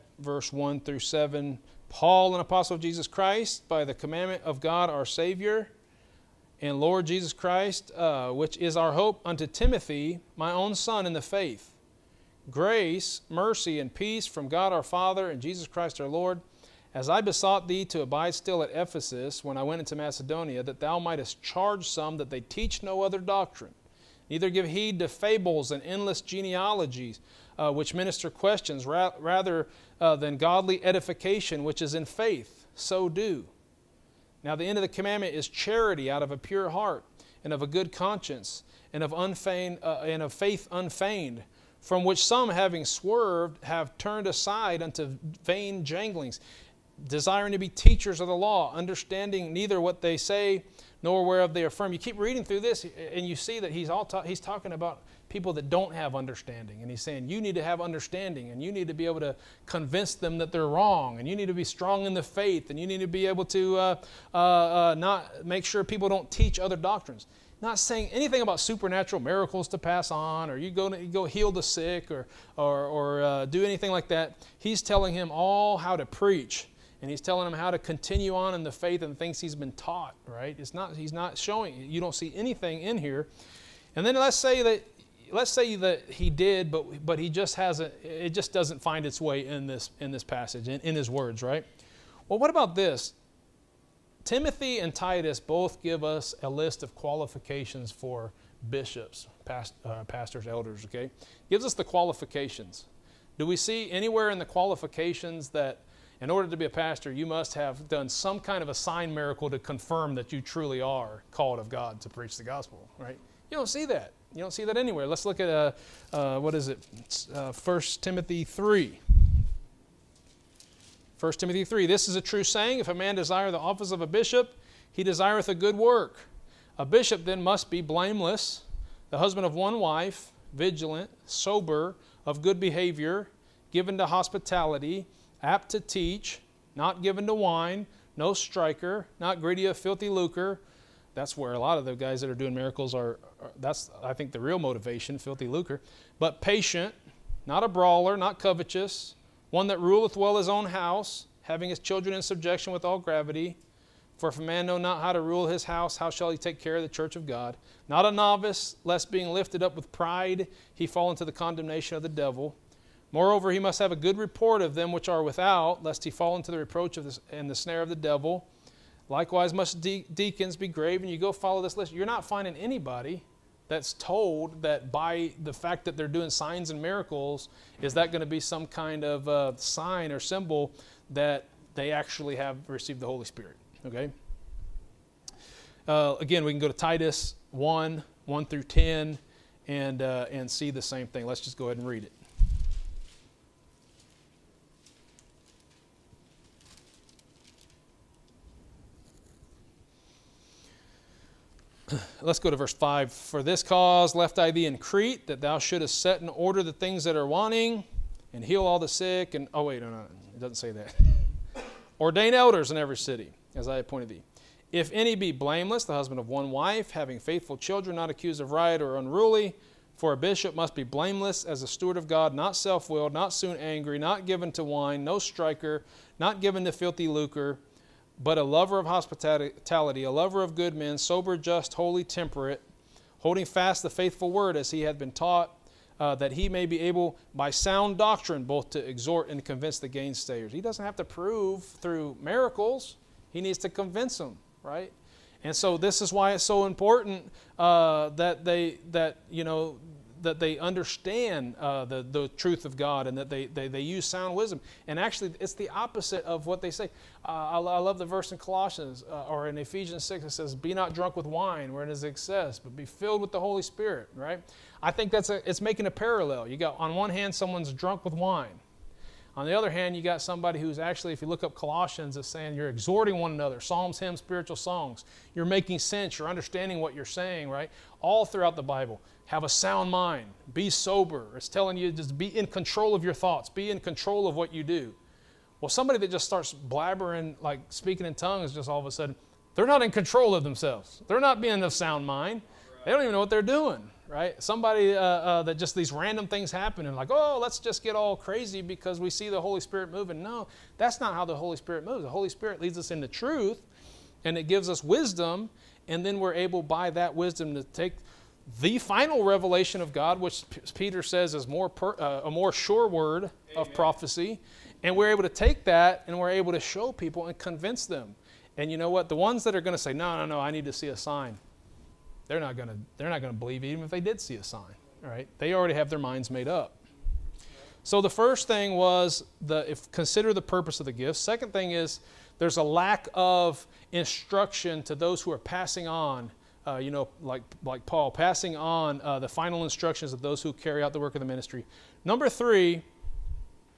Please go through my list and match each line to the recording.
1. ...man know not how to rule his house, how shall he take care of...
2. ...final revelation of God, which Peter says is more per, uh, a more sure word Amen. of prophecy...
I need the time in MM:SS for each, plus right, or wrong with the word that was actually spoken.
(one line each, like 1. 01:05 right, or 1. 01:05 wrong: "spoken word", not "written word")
1. 02:34 right
2. 05:08 right.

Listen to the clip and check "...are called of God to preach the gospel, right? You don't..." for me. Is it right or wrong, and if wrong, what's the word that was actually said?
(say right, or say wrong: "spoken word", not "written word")
right.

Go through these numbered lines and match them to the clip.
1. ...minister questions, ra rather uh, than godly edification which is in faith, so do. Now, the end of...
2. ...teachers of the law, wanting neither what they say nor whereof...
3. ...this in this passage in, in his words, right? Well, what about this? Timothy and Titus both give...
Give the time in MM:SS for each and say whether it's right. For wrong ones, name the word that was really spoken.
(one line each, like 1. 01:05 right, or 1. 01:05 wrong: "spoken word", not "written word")
1. 00:27 right
2. 00:47 wrong: "understanding", not "wanting"
3. 01:29 right.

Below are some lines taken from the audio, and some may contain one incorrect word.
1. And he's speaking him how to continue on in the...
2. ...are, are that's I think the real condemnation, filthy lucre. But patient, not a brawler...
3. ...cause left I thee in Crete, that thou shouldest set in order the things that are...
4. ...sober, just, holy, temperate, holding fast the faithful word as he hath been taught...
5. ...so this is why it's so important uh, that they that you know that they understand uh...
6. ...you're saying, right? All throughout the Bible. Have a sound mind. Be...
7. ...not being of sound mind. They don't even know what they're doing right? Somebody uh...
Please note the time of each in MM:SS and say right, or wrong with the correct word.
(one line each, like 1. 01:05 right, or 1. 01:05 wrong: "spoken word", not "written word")
1. 01:16 wrong: "telling", not "speaking"
2. 02:22 wrong: "motivation", not "condemnation"
3. 03:23 right
4. 03:50 right
5. 04:05 right
6. 04:36 right
7. 04:51 right.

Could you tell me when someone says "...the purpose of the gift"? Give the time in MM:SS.
05:30.